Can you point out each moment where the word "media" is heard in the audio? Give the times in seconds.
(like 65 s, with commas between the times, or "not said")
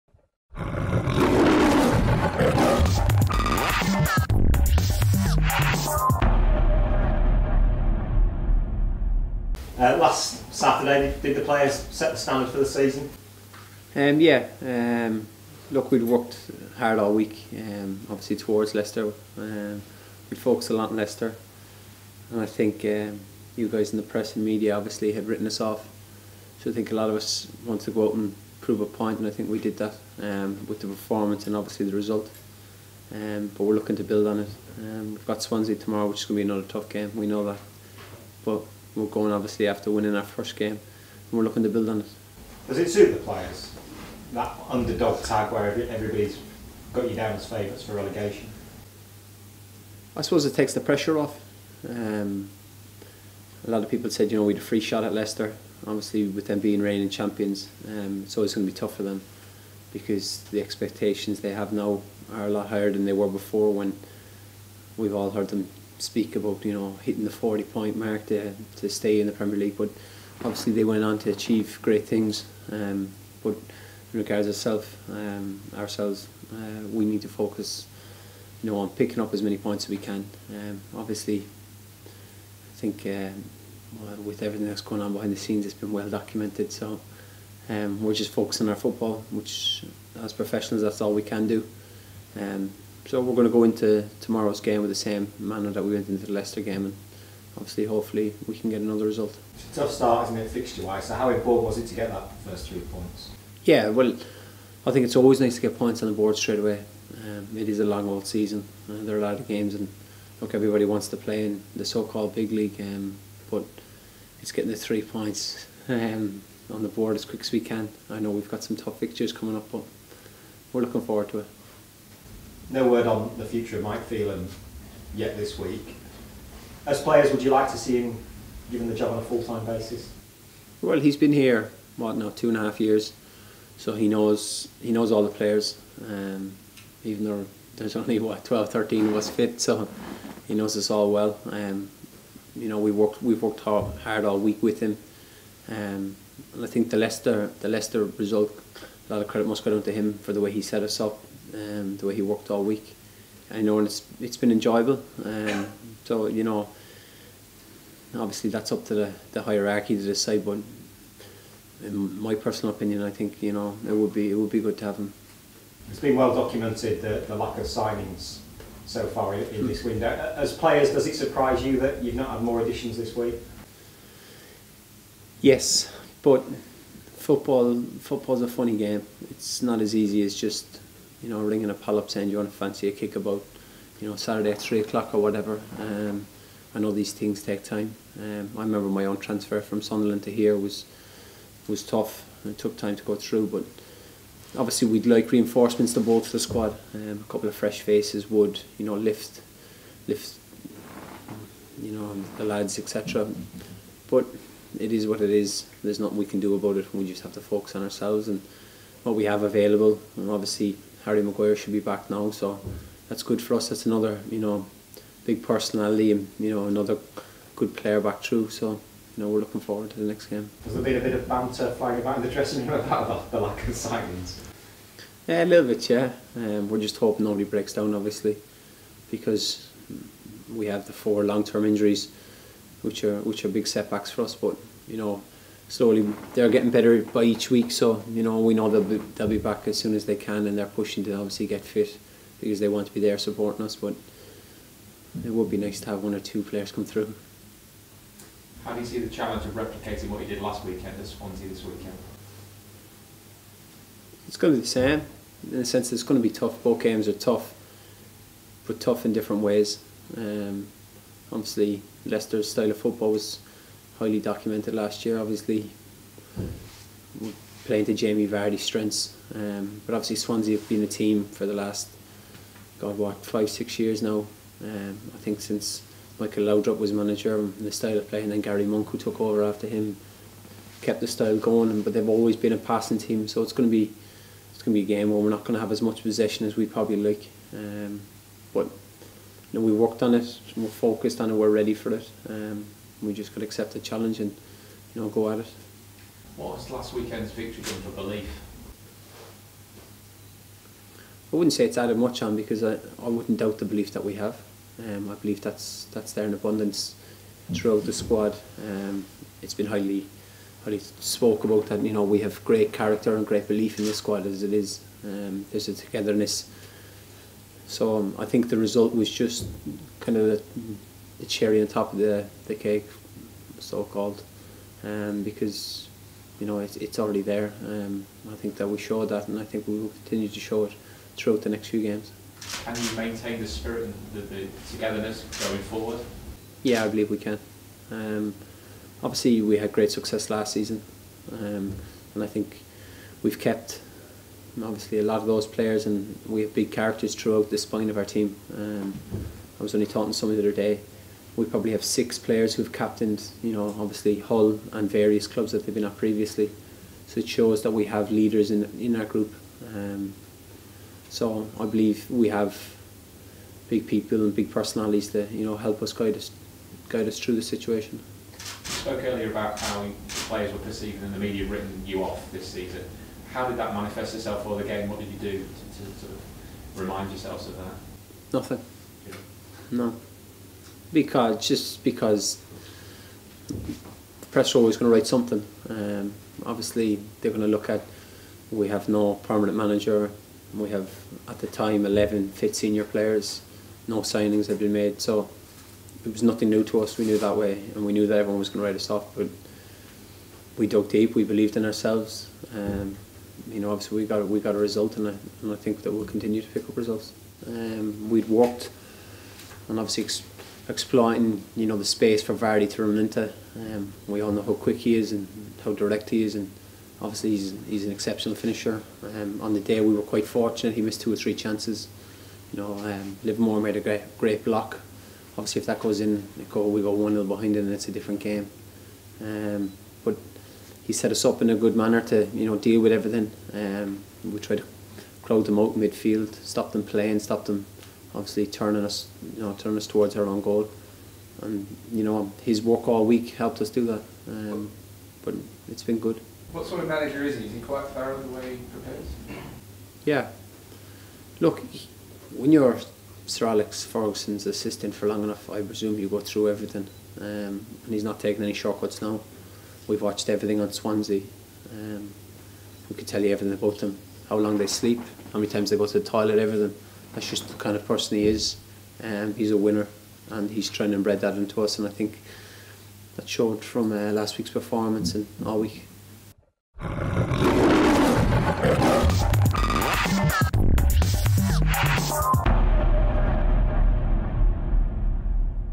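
24 s, 371 s.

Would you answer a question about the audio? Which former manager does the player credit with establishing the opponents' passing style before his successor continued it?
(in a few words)
Michael Laudrup.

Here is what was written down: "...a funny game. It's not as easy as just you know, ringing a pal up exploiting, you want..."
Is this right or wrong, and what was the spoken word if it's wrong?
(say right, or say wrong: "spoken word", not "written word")
wrong: "saying", not "exploiting".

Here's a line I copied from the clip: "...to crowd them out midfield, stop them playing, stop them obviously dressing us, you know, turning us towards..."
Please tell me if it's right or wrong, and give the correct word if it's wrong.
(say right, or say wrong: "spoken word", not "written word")
wrong: "turning", not "dressing".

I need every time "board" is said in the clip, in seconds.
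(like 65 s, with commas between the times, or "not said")
106 s, 116 s.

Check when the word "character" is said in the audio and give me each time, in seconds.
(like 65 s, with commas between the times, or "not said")
312 s, 346 s.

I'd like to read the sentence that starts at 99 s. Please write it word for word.
It's a tough start, isn't it, fixture-wise?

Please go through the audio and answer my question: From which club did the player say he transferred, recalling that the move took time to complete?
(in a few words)
Sunderland.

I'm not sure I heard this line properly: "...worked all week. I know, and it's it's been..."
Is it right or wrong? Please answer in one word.
right.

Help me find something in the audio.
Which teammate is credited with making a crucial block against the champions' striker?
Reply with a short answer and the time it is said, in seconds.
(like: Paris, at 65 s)
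Livermore, at 423 s.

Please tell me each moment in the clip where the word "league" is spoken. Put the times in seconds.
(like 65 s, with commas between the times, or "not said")
69 s, 112 s.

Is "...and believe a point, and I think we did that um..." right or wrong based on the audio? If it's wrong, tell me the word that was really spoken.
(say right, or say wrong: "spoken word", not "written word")
wrong: "prove", not "believe".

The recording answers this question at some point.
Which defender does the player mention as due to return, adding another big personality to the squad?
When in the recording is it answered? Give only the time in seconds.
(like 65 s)
211 s.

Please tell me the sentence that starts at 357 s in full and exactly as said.
So it shows that we have leaders in in our group.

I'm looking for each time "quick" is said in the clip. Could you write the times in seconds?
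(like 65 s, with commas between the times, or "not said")
117 s, 414 s.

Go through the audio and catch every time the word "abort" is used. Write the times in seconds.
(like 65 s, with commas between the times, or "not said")
not said.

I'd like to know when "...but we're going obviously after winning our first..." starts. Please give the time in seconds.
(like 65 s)
38 s.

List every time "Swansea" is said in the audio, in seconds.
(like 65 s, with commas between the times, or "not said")
35 s, 251 s, 270 s, 460 s.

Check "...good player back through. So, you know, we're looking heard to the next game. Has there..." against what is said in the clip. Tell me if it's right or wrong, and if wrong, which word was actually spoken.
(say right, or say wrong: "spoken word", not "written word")
wrong: "forward", not "heard".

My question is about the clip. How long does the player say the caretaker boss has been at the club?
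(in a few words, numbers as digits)
Two and a half years.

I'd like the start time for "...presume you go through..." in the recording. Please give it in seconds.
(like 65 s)
455 s.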